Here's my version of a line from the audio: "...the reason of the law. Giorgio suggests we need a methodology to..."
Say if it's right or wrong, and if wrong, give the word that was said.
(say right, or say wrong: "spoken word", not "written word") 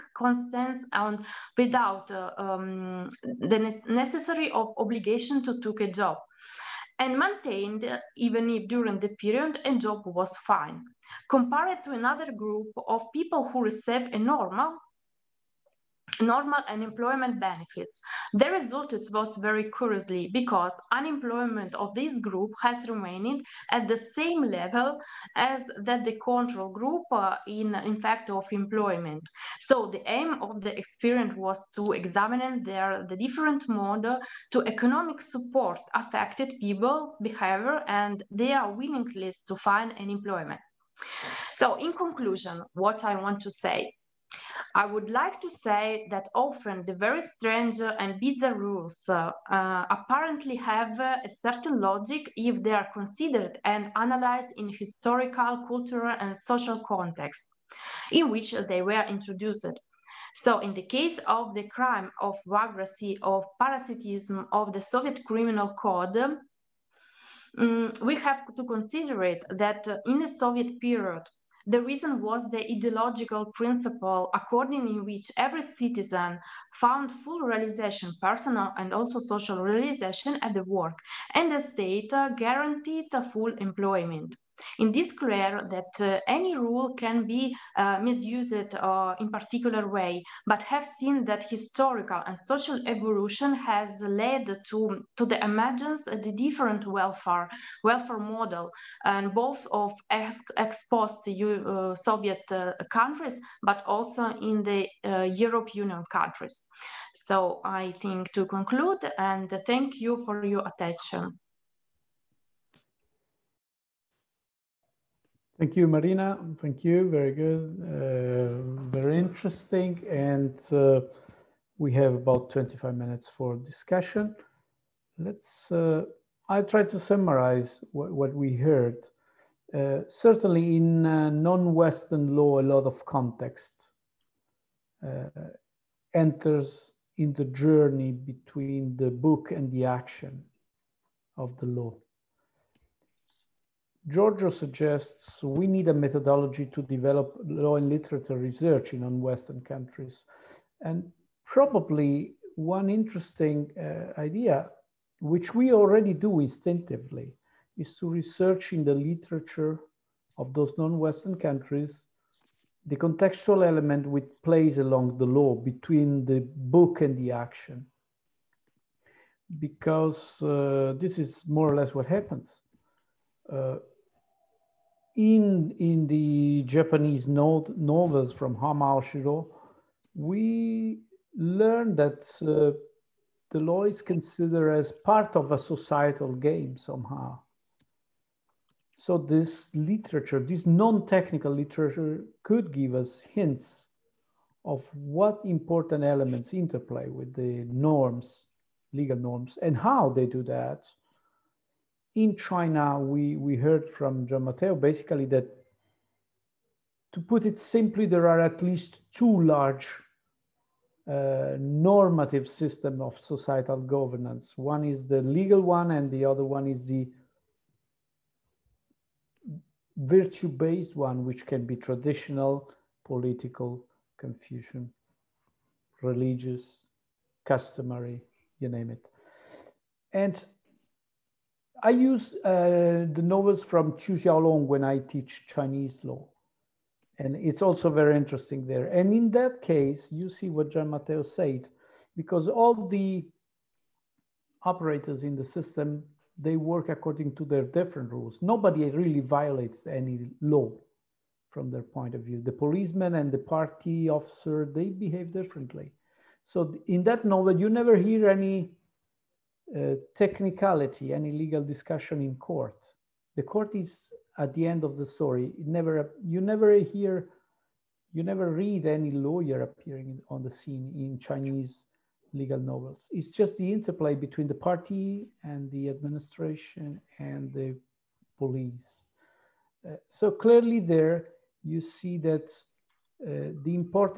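wrong: "action", not "reason".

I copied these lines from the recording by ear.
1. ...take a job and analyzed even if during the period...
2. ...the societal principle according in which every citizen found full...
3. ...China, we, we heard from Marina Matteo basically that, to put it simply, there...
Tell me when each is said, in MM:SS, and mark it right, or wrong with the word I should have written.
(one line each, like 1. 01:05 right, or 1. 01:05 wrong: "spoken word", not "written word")
1. 00:05 wrong: "maintained", not "analyzed"
2. 01:12 wrong: "ideological", not "societal"
3. 03:22 wrong: "Gian", not "Marina".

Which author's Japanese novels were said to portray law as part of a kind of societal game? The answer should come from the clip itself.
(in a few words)
Hamao Shiro.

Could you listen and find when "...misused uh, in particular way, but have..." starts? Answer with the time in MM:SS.
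01:27.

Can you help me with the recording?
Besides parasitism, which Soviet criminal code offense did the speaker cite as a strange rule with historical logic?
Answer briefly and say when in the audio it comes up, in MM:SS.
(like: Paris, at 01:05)
Vagrancy, at 01:02.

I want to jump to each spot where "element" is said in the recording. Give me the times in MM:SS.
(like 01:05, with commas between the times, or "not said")
02:43, 03:16.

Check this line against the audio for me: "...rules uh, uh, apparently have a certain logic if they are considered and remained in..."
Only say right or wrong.
wrong.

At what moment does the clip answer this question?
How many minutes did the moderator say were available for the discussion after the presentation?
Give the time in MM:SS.
02:02.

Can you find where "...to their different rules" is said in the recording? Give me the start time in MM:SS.
04:07.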